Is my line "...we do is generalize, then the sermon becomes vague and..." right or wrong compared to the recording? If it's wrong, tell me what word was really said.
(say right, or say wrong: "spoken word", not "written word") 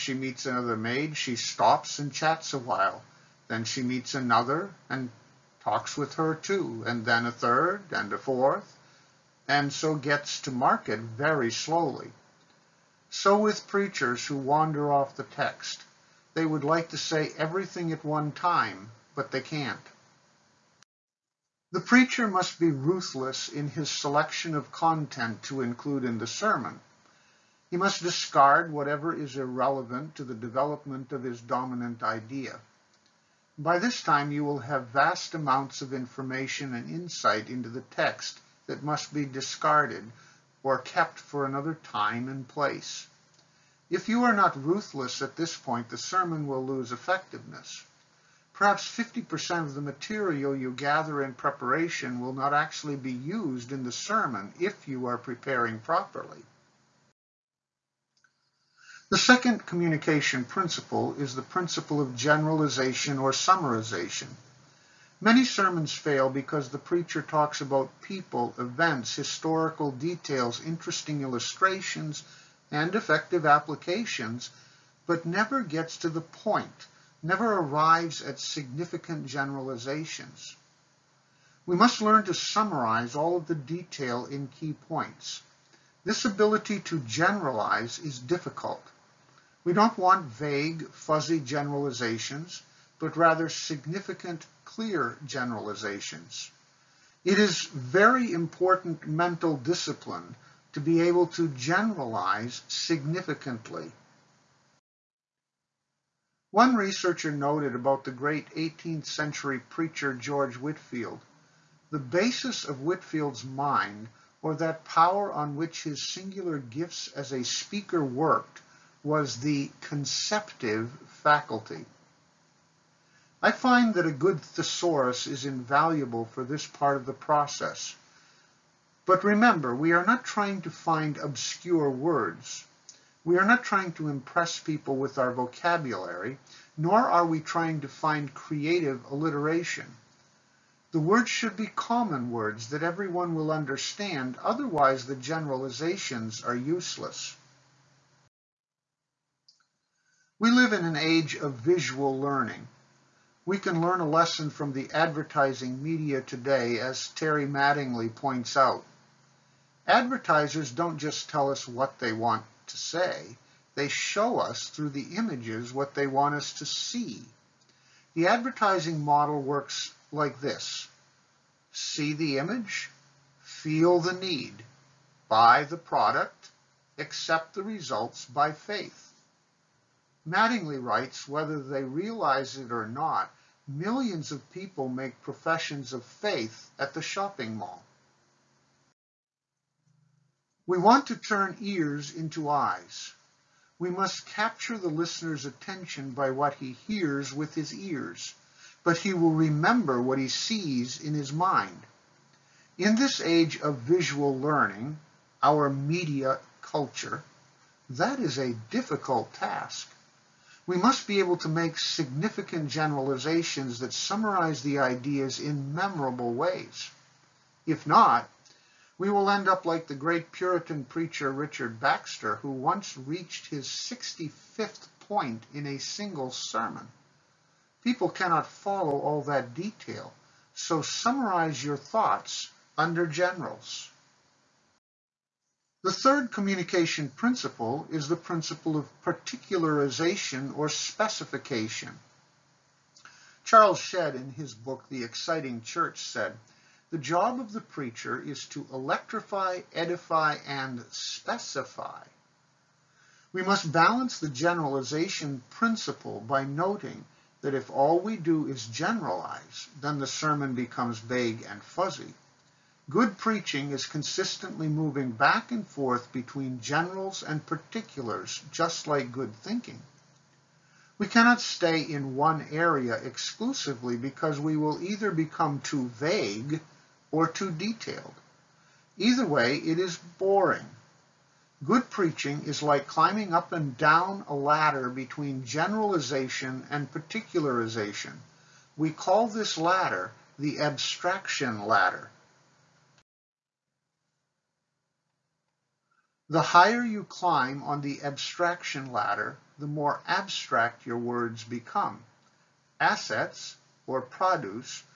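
right.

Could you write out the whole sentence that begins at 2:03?
I find that a good thesaurus is invaluable for this part of the process.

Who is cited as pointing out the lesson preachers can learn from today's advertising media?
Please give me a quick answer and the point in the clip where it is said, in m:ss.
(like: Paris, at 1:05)
Terry Mattingly, at 2:37.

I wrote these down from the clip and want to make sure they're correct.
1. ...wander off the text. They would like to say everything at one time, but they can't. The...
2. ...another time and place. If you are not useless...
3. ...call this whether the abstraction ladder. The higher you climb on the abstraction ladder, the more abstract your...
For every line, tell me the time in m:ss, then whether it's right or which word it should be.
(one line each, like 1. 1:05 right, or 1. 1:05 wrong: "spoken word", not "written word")
1. 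0:14 right
2. 0:41 wrong: "ruthless", not "useless"
3. 4:48 wrong: "ladder", not "whether".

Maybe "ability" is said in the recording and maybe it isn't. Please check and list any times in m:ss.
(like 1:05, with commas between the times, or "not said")
1:26.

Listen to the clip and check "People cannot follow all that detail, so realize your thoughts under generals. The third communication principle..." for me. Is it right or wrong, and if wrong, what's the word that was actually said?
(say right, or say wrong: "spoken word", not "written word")
wrong: "summarize", not "realize".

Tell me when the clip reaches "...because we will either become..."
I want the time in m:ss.
4:33.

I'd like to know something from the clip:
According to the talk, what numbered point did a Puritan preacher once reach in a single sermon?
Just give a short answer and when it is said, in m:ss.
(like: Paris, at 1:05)
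65th, at 3:43.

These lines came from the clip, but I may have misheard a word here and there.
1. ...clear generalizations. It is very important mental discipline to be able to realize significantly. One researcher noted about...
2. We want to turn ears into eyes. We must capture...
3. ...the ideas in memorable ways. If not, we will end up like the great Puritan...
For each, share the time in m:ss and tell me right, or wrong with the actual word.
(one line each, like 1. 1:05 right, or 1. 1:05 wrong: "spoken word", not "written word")
1. 1:34 wrong: "generalize", not "realize"
2. 3:10 right
3. 3:34 right.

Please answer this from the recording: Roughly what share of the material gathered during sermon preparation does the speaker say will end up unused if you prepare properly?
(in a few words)
50%.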